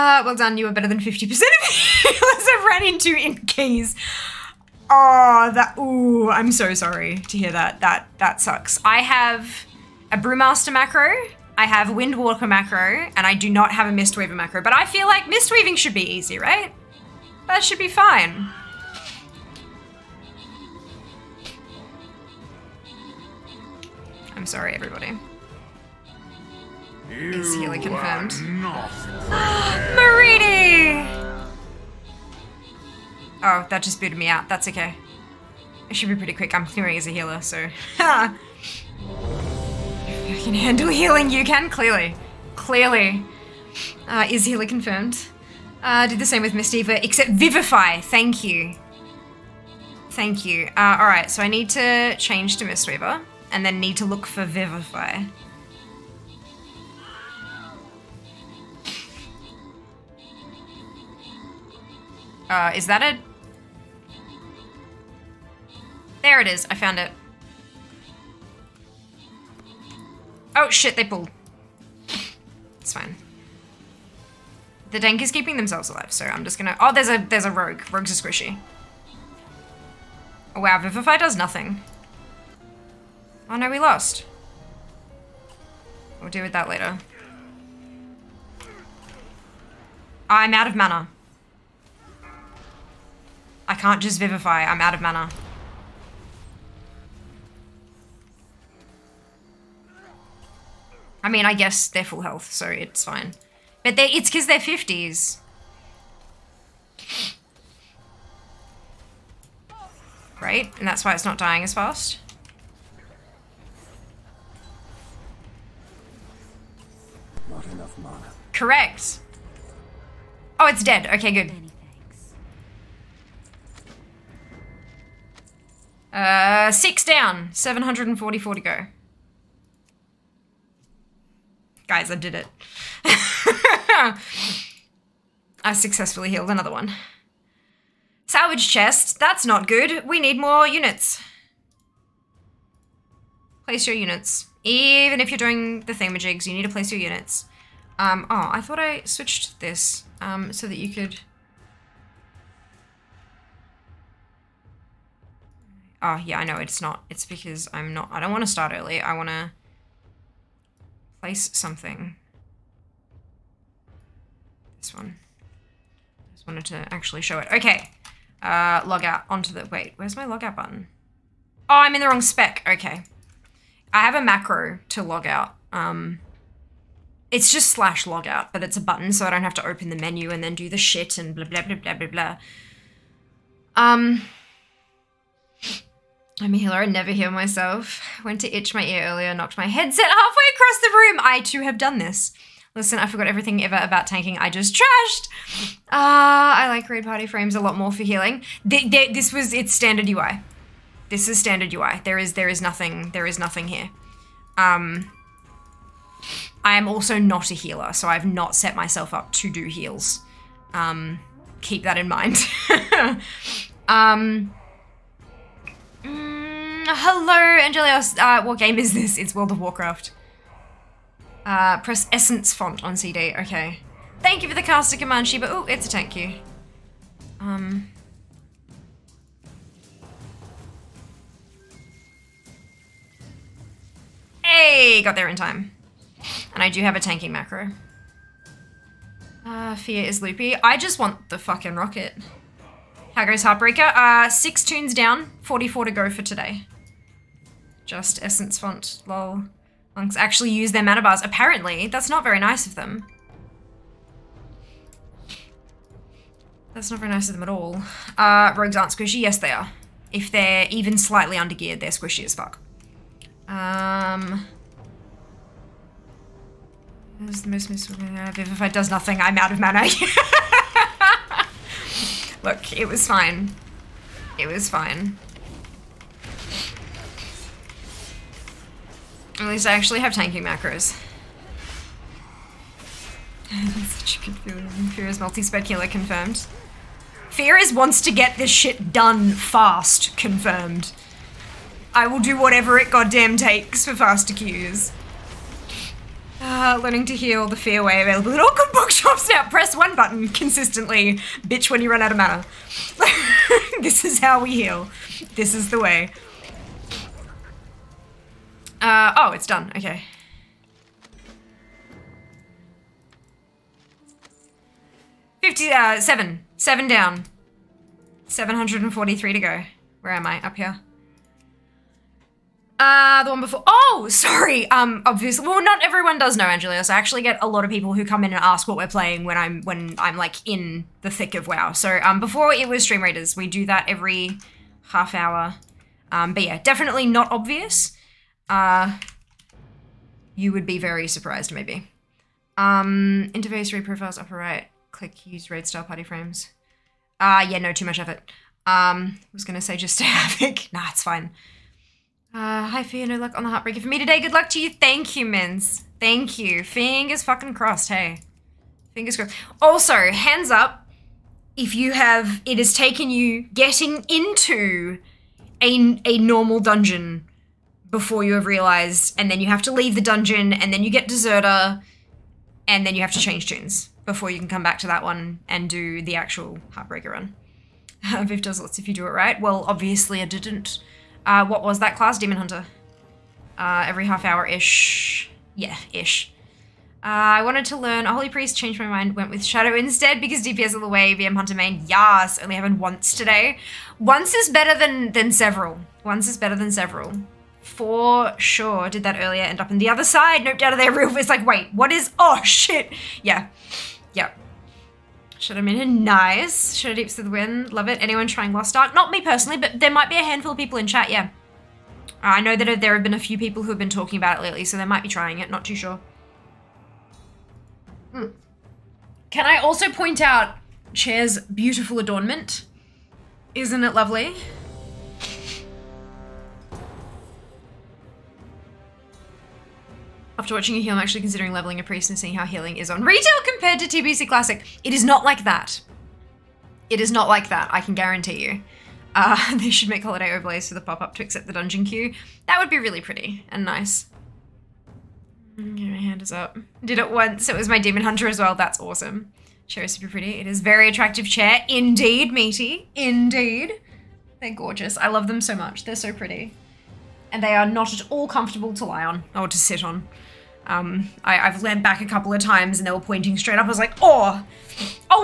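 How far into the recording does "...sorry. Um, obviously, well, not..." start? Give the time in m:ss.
5:24.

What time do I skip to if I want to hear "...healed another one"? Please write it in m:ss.
2:16.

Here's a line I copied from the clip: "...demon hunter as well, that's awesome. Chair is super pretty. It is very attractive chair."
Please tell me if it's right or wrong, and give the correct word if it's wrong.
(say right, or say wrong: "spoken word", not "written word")
right.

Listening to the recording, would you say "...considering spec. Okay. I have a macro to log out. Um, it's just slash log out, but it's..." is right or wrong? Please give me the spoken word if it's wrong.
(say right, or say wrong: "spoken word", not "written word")
wrong: "wrong", not "considering".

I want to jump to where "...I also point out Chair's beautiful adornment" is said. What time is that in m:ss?
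6:59.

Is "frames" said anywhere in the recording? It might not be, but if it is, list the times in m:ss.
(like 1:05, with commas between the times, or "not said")
3:17, 5:46.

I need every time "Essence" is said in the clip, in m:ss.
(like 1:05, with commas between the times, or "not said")
3:42, 4:08.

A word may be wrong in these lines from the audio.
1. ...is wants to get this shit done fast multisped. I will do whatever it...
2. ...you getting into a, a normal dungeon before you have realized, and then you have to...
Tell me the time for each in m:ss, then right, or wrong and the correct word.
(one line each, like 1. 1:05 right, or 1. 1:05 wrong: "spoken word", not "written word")
1. 4:47 wrong: "confirmed", not "multisped"
2. 6:03 right.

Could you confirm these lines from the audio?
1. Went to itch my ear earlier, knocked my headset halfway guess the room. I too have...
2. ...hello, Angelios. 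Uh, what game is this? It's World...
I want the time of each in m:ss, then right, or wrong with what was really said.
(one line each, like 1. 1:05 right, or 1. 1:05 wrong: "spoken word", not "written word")
1. 3:08 wrong: "across", not "guess"
2. 3:36 right.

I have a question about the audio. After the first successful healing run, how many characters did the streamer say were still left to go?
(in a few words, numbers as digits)
744.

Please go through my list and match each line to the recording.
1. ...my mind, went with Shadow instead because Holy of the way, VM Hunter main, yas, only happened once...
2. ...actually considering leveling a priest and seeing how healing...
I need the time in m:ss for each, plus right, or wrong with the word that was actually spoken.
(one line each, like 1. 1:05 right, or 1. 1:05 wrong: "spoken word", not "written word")
1. 6:28 wrong: "DPS", not "Holy"
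2. 7:10 right.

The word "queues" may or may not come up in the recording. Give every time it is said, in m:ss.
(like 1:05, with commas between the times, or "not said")
4:54, 7:21.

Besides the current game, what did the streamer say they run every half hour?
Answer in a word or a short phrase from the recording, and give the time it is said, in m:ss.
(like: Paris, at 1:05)
Stream Raiders, at 5:32.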